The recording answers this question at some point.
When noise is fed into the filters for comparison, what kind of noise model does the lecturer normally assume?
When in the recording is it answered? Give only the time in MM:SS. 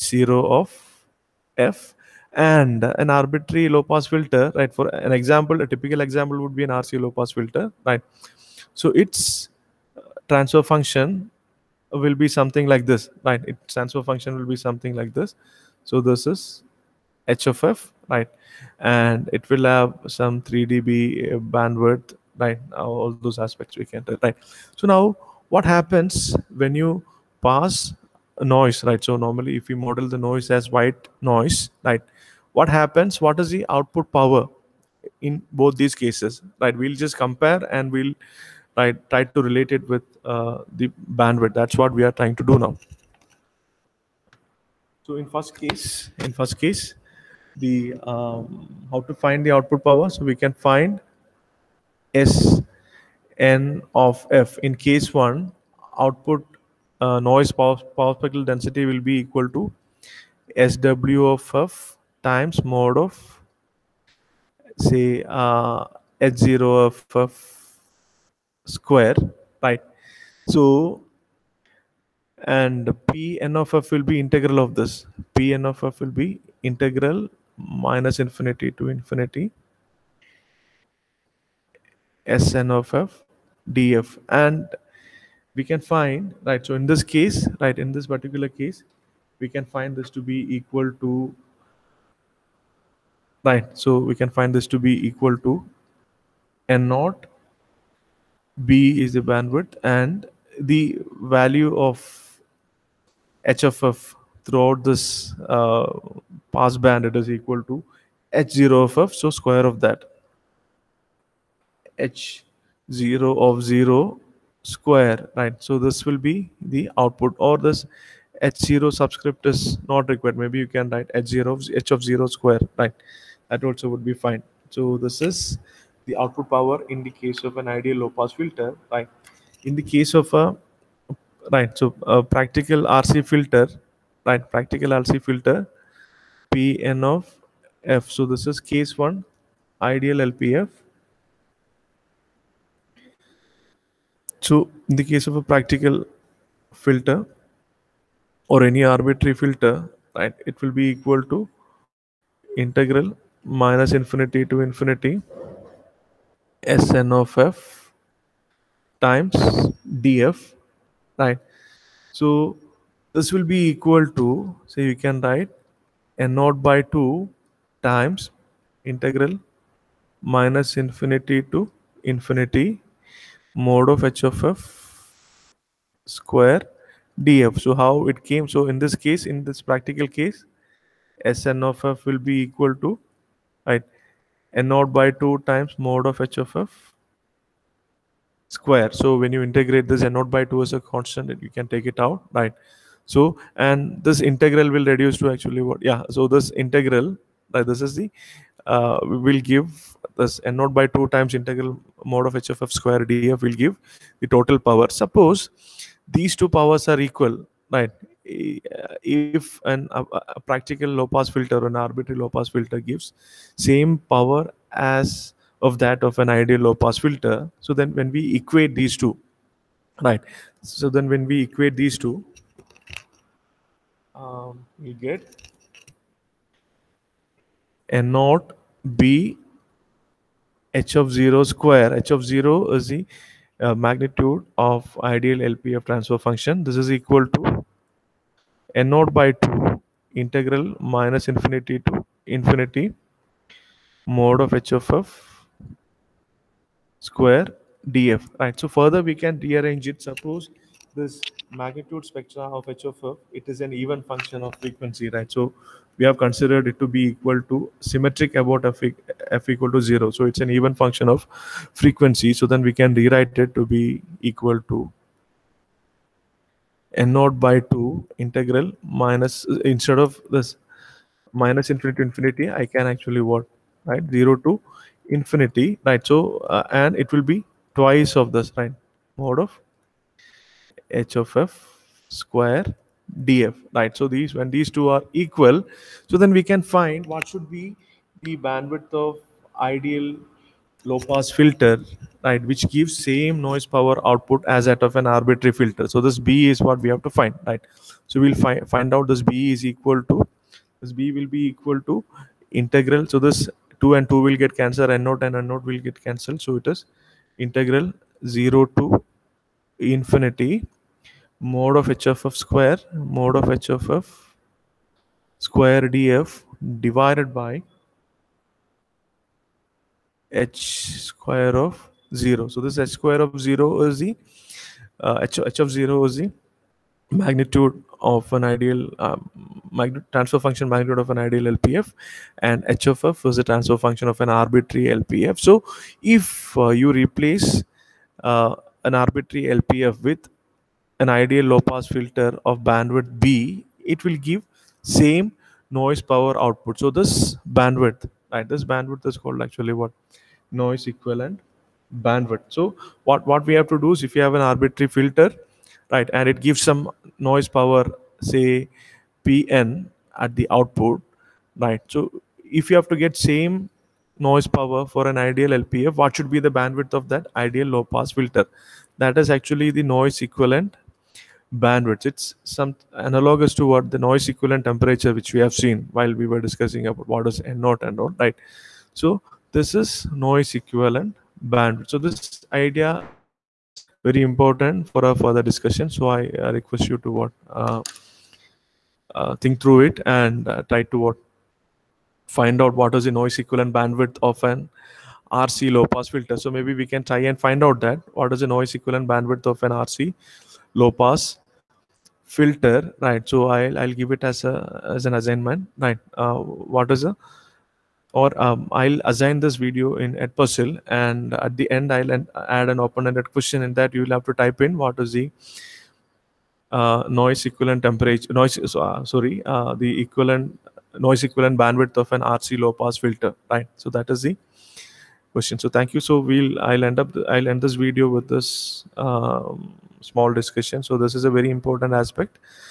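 00:30.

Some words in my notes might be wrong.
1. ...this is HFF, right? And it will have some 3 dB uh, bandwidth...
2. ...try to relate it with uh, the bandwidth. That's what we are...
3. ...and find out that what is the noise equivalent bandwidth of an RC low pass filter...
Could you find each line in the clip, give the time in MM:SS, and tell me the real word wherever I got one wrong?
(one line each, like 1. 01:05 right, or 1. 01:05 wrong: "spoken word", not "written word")
1. 00:15 right
2. 00:39 right
3. 06:37 right.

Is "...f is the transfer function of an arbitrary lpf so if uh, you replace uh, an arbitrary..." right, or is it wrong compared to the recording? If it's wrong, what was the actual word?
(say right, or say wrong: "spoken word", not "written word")
right.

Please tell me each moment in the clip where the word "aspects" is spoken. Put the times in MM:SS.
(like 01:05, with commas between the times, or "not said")
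00:23, 07:11.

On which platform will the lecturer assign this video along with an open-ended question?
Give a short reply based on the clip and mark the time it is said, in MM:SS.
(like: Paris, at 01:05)
Edpuzzle, at 06:50.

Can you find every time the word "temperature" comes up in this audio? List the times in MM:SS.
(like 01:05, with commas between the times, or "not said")
06:14, 06:57.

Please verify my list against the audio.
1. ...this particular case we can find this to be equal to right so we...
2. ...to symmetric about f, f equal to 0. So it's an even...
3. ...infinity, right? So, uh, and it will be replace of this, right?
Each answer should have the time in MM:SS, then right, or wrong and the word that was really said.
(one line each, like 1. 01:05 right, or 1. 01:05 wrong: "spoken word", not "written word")
1. 01:27 right
2. 04:17 right
3. 04:35 wrong: "twice", not "replace".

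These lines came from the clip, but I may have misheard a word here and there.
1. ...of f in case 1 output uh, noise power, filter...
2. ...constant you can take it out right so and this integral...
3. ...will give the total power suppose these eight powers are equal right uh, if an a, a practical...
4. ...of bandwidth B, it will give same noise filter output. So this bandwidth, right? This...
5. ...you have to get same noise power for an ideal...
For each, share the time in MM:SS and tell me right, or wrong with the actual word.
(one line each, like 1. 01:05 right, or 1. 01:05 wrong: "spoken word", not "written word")
1. 00:53 wrong: "power", not "filter"
2. 03:10 right
3. 03:23 wrong: "two", not "eight"
4. 05:42 wrong: "power", not "filter"
5. 06:02 right.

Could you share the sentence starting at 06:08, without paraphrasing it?
That is actually the noise equivalent bandwidth.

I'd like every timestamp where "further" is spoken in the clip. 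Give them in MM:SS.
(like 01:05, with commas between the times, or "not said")
04:08, 06:25.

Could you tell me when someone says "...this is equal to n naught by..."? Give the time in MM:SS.
03:56.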